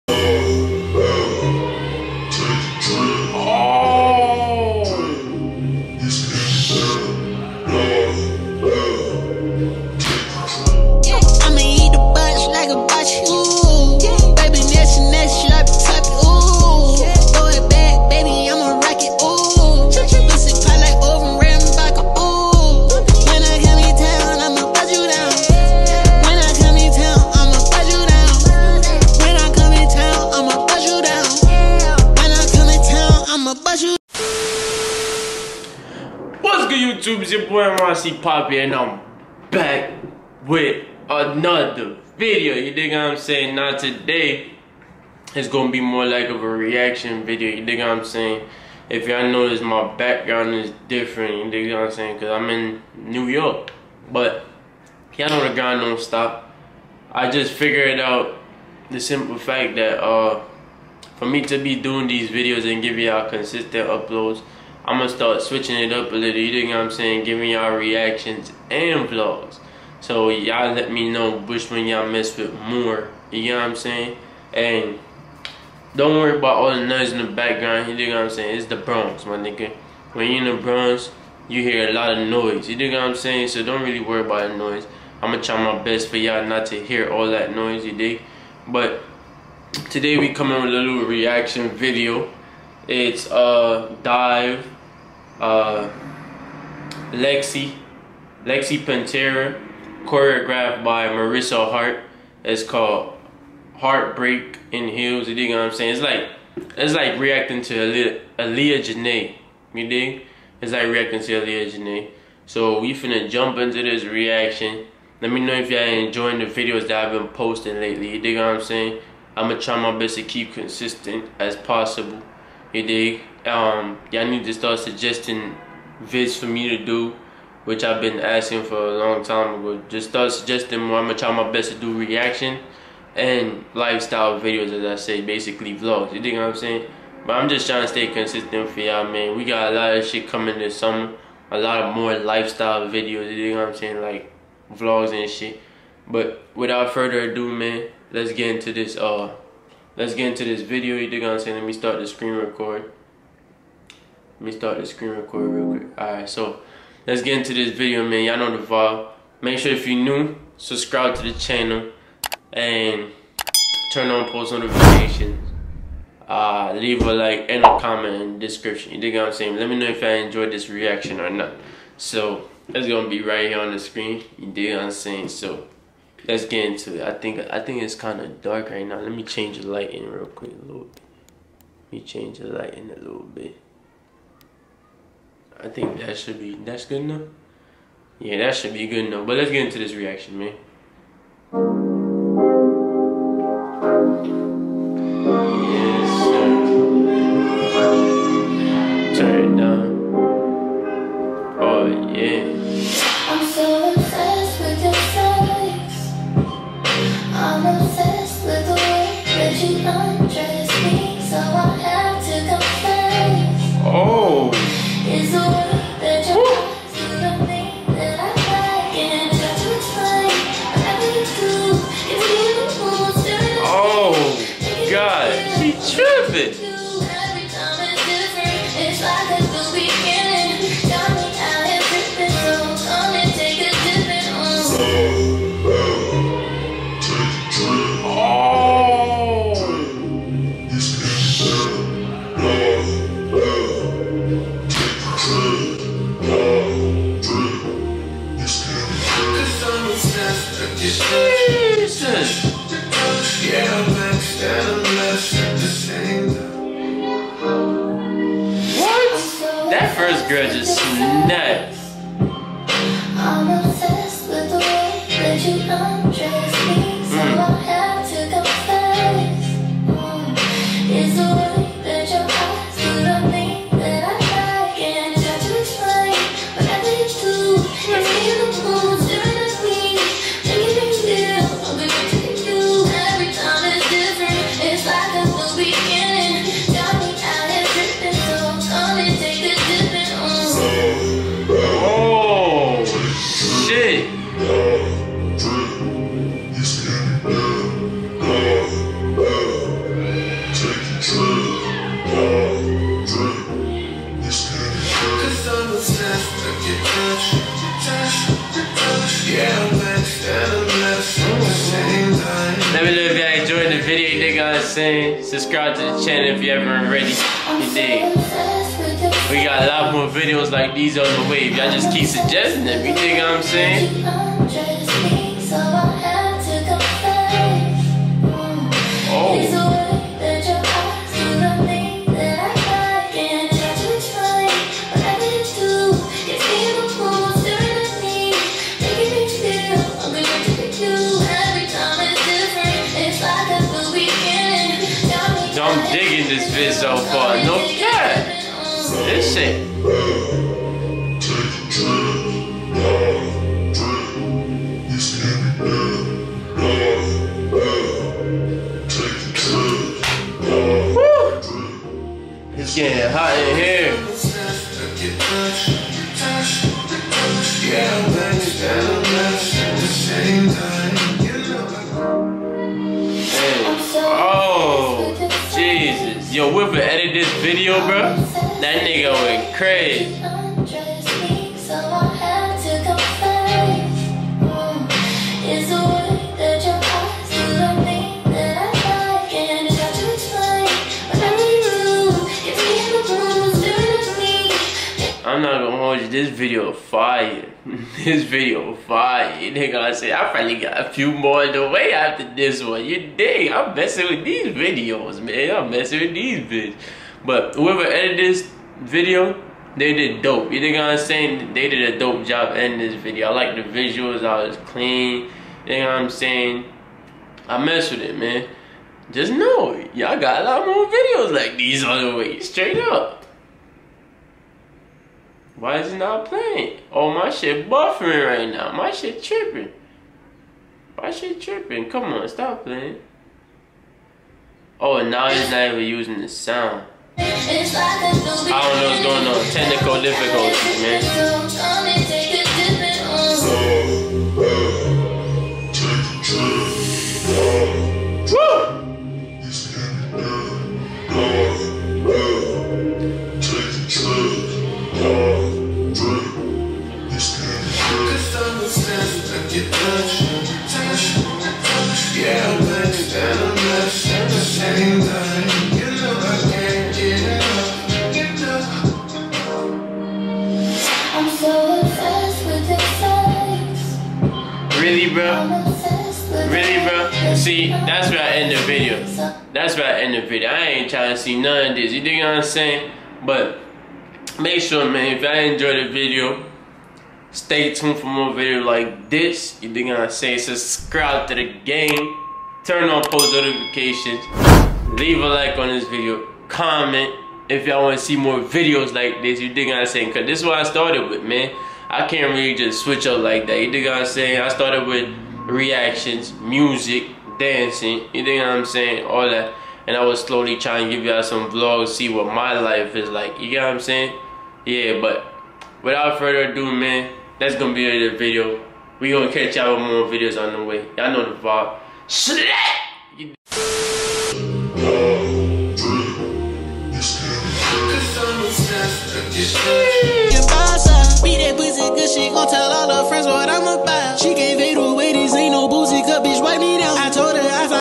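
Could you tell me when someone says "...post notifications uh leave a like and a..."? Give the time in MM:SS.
02:44.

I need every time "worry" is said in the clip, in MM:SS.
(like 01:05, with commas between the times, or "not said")
01:16, 01:23.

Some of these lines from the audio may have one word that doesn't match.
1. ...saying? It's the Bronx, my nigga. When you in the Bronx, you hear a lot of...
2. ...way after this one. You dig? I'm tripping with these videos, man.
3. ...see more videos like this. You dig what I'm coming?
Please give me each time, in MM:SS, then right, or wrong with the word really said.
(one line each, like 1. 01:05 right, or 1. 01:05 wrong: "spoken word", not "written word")
1. 01:18 right
2. 06:41 wrong: "messing", not "tripping"
3. 08:18 wrong: "saying", not "coming".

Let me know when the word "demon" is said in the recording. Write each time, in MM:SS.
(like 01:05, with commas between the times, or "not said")
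not said.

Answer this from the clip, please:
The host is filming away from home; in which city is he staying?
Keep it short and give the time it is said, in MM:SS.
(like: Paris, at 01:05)
New York, at 00:52.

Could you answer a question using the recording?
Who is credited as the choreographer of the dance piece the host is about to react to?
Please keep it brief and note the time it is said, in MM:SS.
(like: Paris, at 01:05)
Marissa Heart, at 01:41.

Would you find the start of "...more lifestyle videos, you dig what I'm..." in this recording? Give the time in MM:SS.
02:21.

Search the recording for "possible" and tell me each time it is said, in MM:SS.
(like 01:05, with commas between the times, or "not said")
02:01.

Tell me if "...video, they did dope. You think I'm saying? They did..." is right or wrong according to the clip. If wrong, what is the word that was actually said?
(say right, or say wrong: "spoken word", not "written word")
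right.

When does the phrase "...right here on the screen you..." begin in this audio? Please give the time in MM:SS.
02:53.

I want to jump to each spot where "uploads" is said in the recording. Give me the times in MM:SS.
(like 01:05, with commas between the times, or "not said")
01:03.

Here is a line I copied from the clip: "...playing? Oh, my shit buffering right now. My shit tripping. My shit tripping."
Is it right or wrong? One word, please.
right.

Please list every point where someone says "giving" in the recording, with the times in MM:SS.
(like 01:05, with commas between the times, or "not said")
01:02, 01:07.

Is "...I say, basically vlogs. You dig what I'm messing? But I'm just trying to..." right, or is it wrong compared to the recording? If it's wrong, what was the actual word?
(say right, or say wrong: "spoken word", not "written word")
wrong: "saying", not "messing".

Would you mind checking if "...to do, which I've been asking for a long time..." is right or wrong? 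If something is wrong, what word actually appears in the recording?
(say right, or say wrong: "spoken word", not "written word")
right.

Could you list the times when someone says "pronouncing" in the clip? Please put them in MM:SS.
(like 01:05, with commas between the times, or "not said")
not said.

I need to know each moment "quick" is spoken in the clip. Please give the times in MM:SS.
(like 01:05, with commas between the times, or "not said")
02:35, 03:00.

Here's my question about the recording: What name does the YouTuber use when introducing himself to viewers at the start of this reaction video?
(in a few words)
Rossi Poppy.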